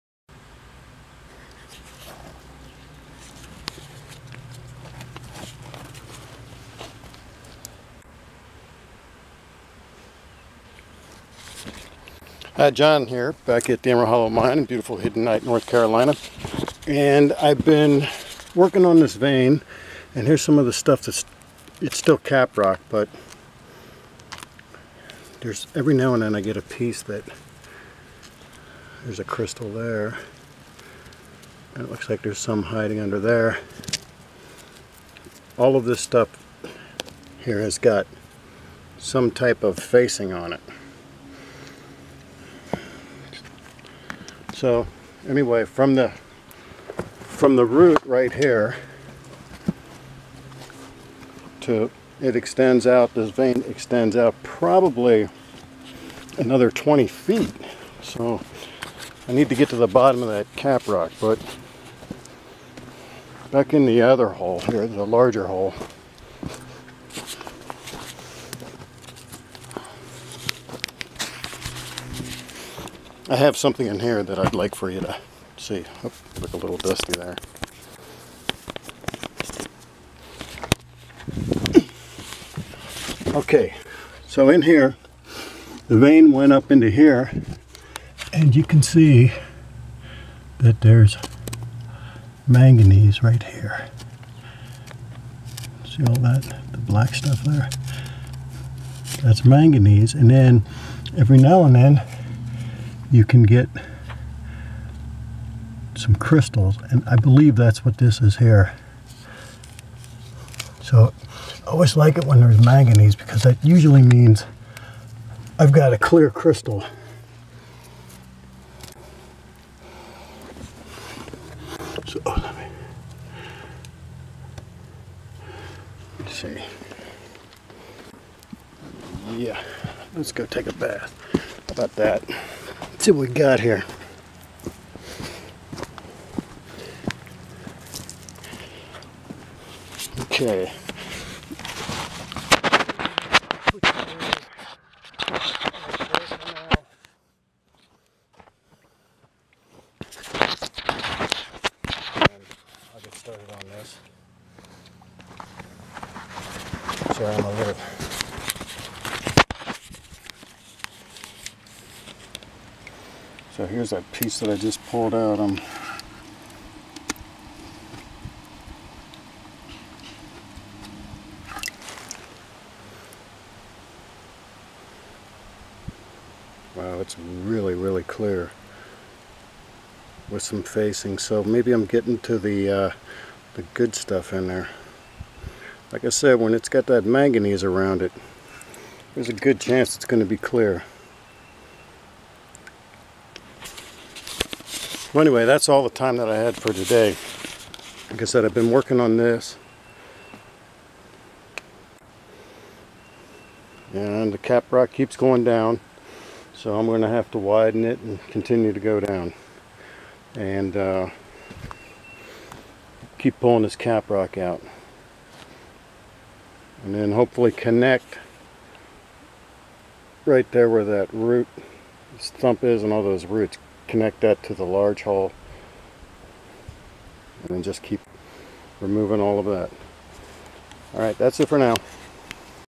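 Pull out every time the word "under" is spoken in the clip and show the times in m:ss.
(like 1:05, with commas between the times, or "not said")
0:32.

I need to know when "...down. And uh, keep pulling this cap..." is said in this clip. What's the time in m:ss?
3:29.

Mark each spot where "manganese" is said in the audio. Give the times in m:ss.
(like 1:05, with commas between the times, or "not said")
1:32, 1:39, 1:52, 3:07.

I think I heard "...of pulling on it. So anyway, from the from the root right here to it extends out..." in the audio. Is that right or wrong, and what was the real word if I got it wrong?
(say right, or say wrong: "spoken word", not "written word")
wrong: "facing", not "pulling".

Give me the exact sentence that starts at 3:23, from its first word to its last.
And the cap rock keeps going down.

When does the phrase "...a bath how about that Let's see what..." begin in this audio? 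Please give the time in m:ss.
2:10.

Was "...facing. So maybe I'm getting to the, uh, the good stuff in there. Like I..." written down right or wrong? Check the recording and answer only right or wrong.
right.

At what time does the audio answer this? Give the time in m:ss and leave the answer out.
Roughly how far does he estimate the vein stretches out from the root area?
0:56.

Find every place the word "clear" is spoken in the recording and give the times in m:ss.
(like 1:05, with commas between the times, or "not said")
1:55, 2:58, 3:10.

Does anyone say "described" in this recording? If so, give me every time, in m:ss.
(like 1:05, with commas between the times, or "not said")
not said.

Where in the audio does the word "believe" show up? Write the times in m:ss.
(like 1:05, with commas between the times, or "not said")
1:47.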